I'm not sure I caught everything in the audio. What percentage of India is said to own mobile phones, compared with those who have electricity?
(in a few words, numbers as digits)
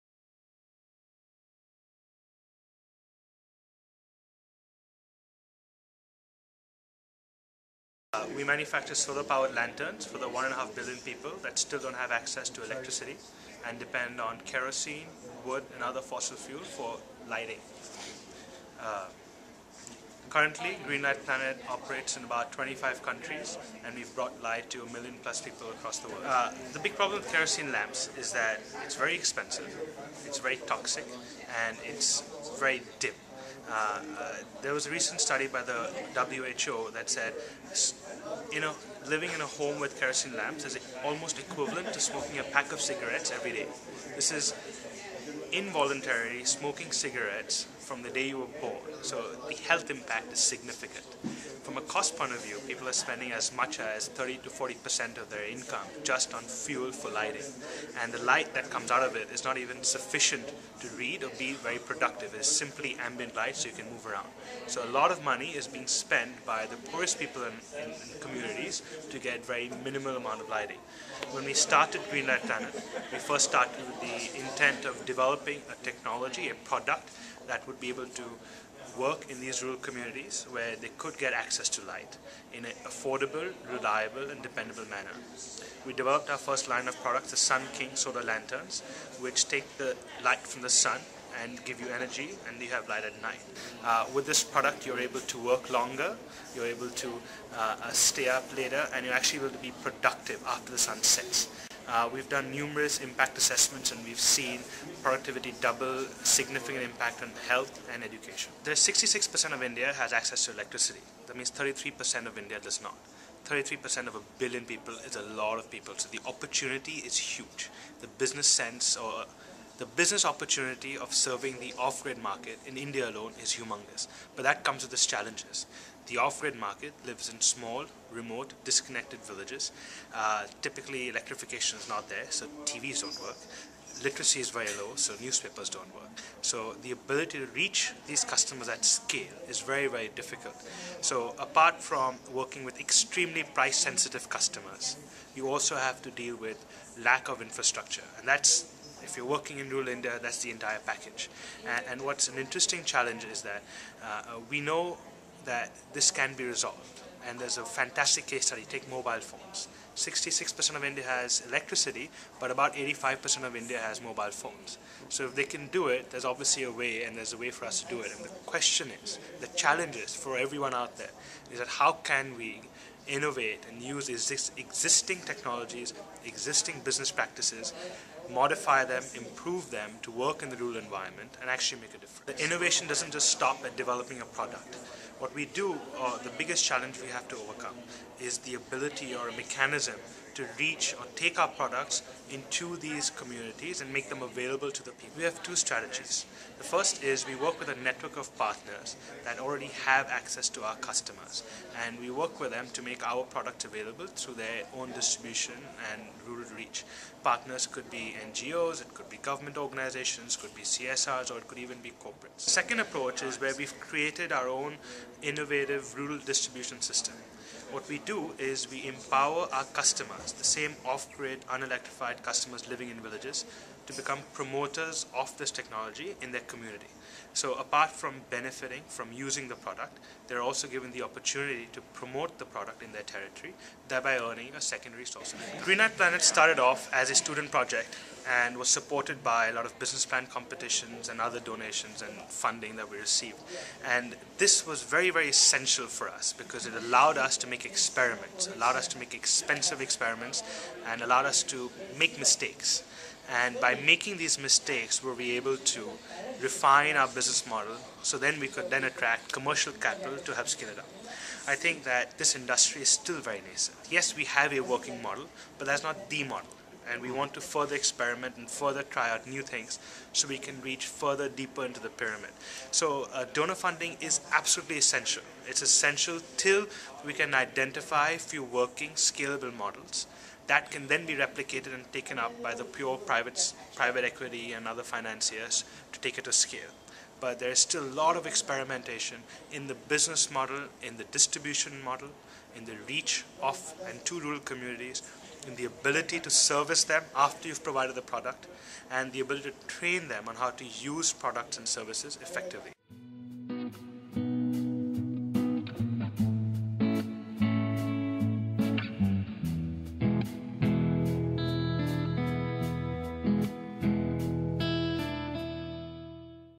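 85%.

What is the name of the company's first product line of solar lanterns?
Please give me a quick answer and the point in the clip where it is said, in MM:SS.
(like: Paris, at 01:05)
Sun King, at 01:27.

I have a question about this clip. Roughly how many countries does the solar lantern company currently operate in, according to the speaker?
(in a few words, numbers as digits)
25.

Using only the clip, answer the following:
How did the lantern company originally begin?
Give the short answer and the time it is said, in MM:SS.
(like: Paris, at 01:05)
student project, at 03:57.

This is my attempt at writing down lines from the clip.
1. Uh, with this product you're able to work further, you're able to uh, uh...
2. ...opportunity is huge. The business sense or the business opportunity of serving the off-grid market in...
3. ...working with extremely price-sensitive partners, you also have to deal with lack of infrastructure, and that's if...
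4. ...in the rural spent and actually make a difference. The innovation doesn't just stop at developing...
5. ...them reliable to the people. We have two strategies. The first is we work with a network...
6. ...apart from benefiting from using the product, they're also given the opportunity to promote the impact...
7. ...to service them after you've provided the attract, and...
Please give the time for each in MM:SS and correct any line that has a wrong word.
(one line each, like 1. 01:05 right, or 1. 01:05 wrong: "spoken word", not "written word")
1. 01:33 wrong: "longer", not "further"
2. 01:56 right
3. 02:22 wrong: "customers", not "partners"
4. 03:00 wrong: "environment", not "spent"
5. 03:14 wrong: "available", not "reliable"
6. 03:47 wrong: "product", not "impact"
7. 04:56 wrong: "product", not "attract".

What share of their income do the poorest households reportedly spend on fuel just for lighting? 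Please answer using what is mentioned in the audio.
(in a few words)
30 to 40 percent.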